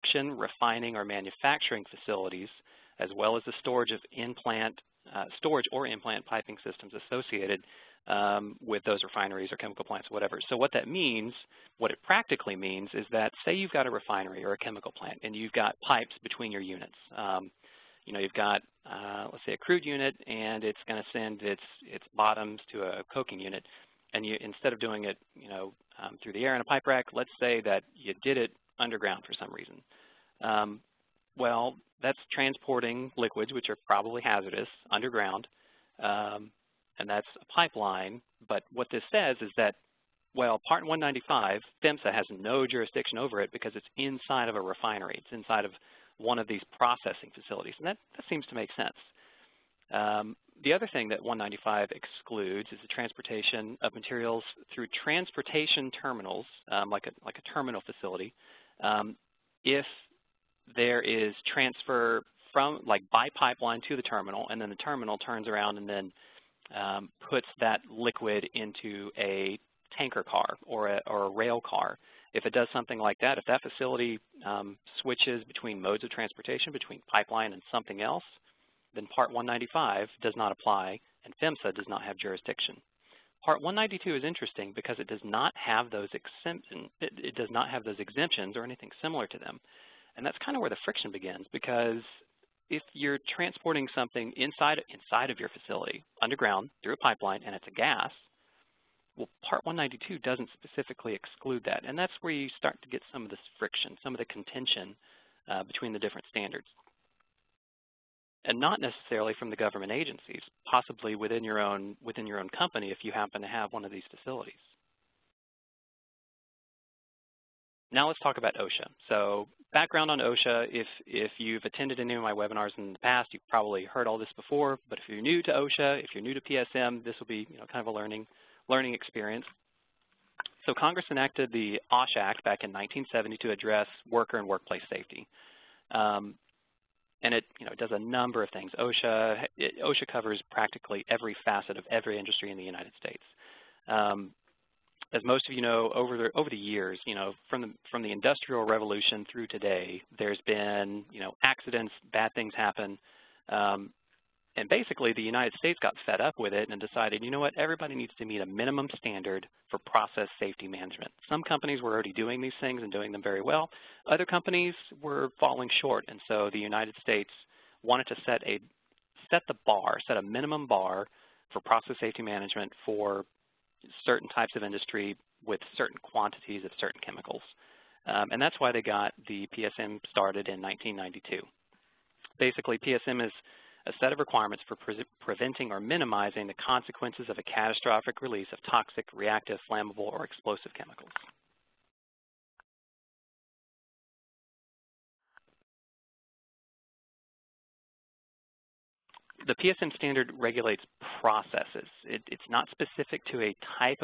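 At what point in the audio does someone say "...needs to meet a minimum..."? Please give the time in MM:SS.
02:37.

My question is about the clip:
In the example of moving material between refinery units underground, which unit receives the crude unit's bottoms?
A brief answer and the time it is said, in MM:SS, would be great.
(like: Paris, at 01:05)
coking unit, at 00:23.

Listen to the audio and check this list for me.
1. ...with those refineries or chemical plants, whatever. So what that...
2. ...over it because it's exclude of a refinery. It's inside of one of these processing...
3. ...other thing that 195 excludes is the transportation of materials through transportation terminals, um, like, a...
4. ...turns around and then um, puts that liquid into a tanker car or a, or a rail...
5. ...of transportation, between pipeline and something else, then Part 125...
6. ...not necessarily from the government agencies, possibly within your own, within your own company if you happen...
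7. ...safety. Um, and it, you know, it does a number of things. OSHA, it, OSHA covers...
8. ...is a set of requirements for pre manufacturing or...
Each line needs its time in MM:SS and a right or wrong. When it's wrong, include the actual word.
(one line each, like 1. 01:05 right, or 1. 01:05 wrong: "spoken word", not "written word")
1. 00:08 right
2. 00:43 wrong: "inside", not "exclude"
3. 00:50 right
4. 01:05 right
5. 01:16 wrong: "195", not "125"
6. 01:48 right
7. 02:14 right
8. 03:03 wrong: "preventing", not "manufacturing".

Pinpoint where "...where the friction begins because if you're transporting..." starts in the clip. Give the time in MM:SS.
01:30.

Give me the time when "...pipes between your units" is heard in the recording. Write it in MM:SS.
00:15.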